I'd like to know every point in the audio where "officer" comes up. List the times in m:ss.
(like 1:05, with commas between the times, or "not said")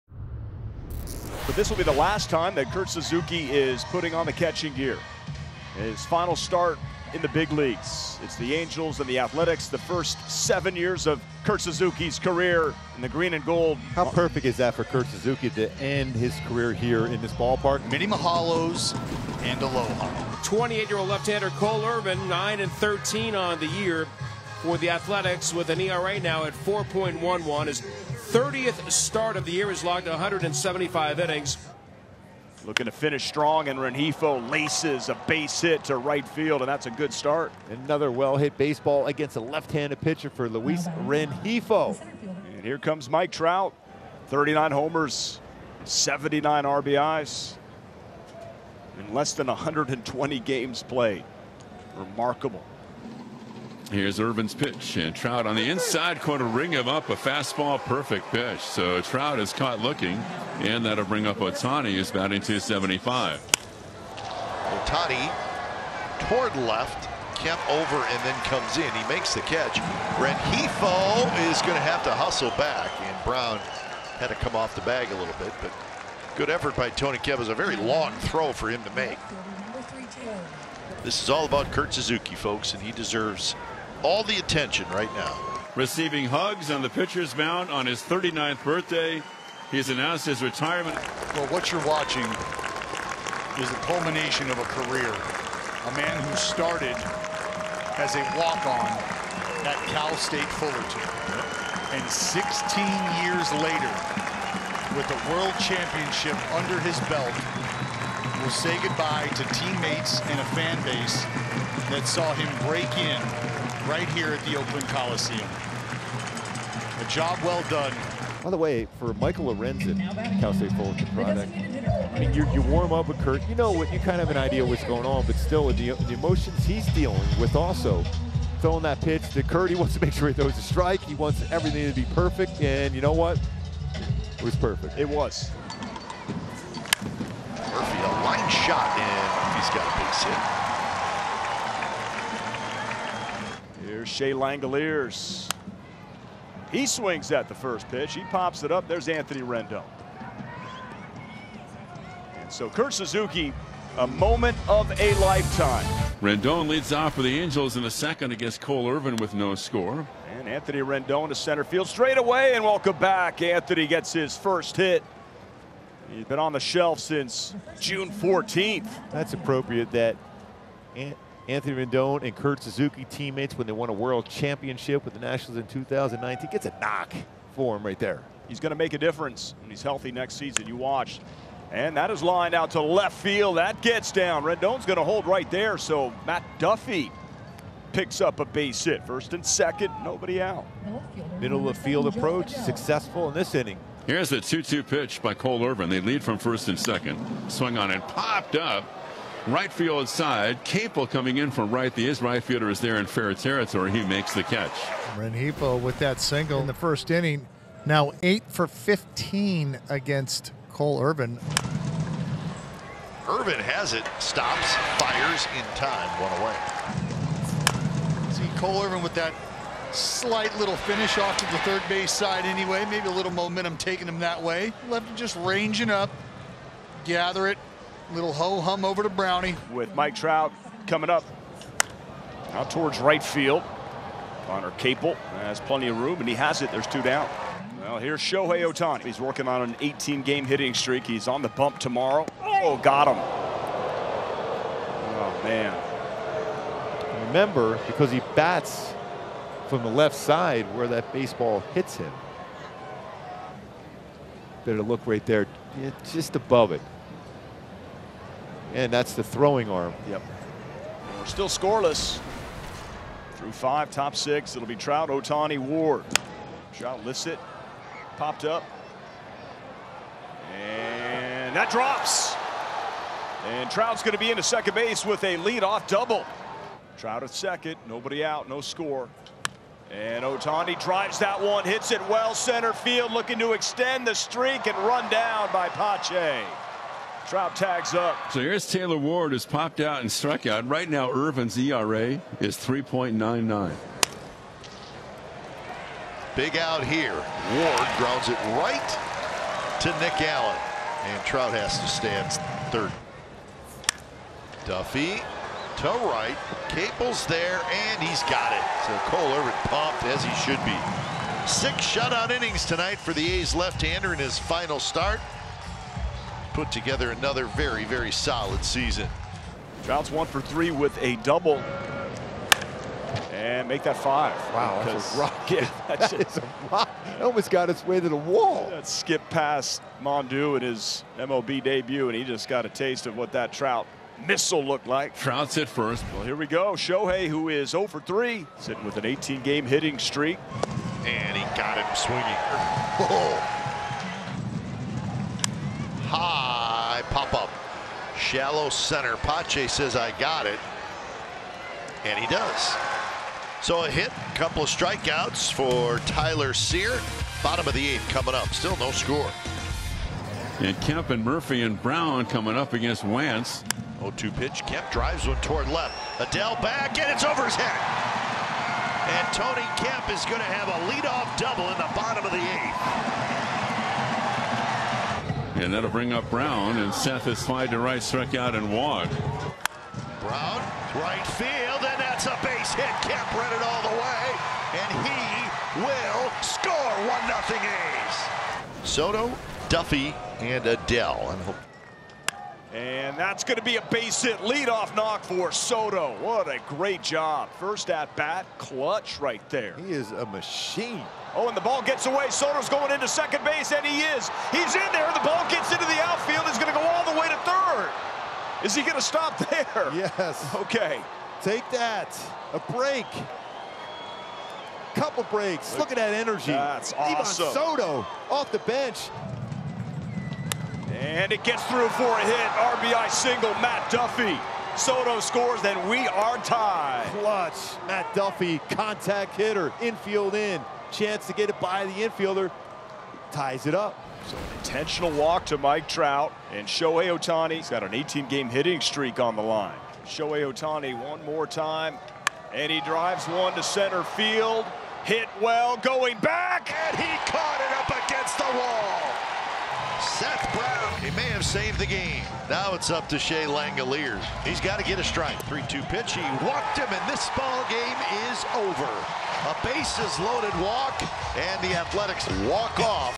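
not said.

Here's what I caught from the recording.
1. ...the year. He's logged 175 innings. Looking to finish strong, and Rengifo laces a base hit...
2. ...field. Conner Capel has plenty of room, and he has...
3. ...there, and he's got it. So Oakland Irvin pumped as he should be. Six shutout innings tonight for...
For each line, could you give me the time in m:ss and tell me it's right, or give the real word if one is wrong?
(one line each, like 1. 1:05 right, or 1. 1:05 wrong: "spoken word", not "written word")
1. 0:29 right
2. 3:53 right
3. 5:07 wrong: "Cole", not "Oakland".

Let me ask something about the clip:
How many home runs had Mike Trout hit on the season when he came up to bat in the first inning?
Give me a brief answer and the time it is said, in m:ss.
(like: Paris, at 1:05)
39, at 0:44.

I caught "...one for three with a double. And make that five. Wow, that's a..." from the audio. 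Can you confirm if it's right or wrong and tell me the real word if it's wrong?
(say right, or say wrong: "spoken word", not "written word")
right.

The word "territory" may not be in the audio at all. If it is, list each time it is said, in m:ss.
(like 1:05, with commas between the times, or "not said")
3:23.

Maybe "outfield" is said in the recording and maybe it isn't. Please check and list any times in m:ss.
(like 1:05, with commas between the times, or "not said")
6:46.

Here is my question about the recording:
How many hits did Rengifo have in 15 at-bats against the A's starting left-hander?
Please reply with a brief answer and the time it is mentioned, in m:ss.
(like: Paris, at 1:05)
8, at 3:28.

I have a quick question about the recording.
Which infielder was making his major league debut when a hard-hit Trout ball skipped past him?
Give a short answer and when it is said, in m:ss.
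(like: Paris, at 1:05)
Mondou, at 5:30.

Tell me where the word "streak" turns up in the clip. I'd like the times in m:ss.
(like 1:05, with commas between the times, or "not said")
4:00, 4:44, 5:39, 7:18.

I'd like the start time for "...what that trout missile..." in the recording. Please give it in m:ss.
5:33.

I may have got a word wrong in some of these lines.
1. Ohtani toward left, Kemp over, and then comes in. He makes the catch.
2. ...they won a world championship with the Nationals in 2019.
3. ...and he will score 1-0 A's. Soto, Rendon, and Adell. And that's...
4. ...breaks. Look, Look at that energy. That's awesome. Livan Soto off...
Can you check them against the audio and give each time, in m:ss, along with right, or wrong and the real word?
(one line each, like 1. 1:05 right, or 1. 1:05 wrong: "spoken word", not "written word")
1. 1:04 right
2. 2:53 right
3. 6:24 wrong: "Duffy", not "Rendon"
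4. 6:55 right.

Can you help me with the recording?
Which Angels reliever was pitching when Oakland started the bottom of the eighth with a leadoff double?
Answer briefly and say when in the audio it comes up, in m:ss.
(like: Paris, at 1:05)
Wantz, at 6:03.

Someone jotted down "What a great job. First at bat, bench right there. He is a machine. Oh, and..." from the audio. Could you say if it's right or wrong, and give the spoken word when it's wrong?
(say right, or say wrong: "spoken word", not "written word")
wrong: "clutch", not "bench".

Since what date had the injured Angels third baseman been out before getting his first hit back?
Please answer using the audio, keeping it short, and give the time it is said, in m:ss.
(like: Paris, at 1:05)
June 14th, at 2:47.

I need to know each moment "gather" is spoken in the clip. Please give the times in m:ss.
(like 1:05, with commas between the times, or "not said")
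3:47.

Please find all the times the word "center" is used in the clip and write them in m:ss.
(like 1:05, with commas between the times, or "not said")
2:41, 4:42, 5:48, 7:23.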